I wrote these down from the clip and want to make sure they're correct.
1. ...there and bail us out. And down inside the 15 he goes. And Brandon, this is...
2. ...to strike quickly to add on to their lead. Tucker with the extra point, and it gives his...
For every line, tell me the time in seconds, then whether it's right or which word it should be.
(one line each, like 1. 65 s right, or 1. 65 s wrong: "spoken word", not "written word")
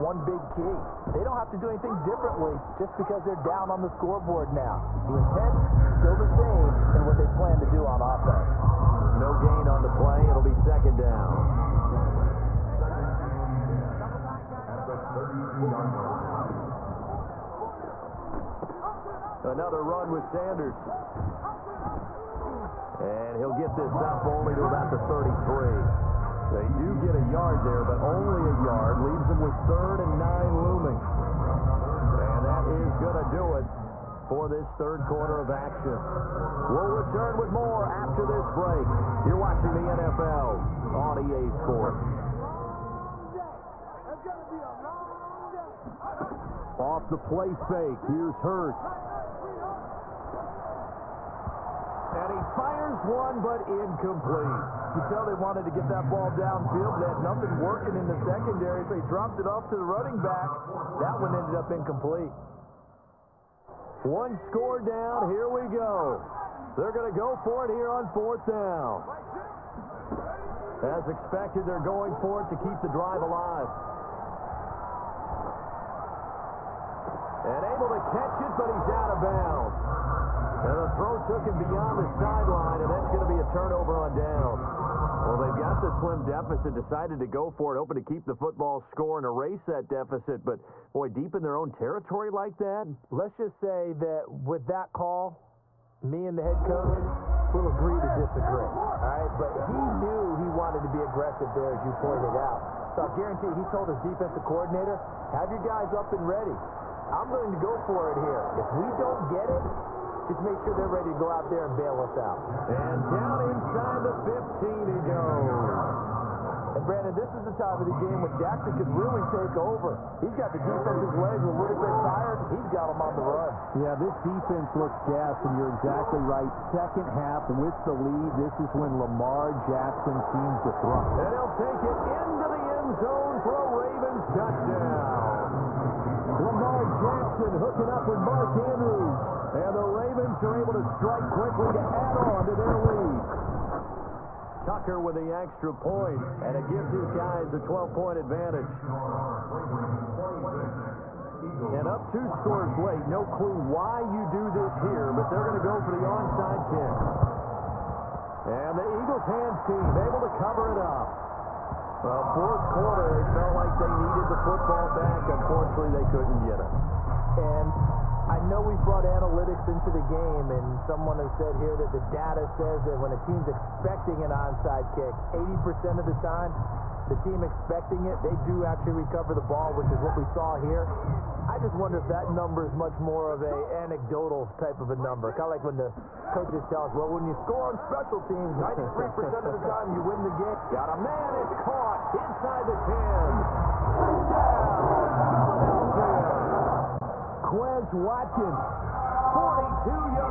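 1. 111 s right
2. 140 s right.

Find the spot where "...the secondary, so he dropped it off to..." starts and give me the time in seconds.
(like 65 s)
58 s.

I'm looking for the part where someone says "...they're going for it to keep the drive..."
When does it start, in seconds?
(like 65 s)
71 s.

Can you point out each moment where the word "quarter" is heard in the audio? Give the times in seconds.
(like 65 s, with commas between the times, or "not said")
35 s, 162 s.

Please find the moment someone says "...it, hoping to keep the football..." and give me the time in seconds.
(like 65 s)
87 s.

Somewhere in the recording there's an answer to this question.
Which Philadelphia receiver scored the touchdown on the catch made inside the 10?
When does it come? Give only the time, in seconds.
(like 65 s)
197 s.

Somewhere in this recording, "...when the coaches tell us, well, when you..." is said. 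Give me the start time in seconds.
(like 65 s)
185 s.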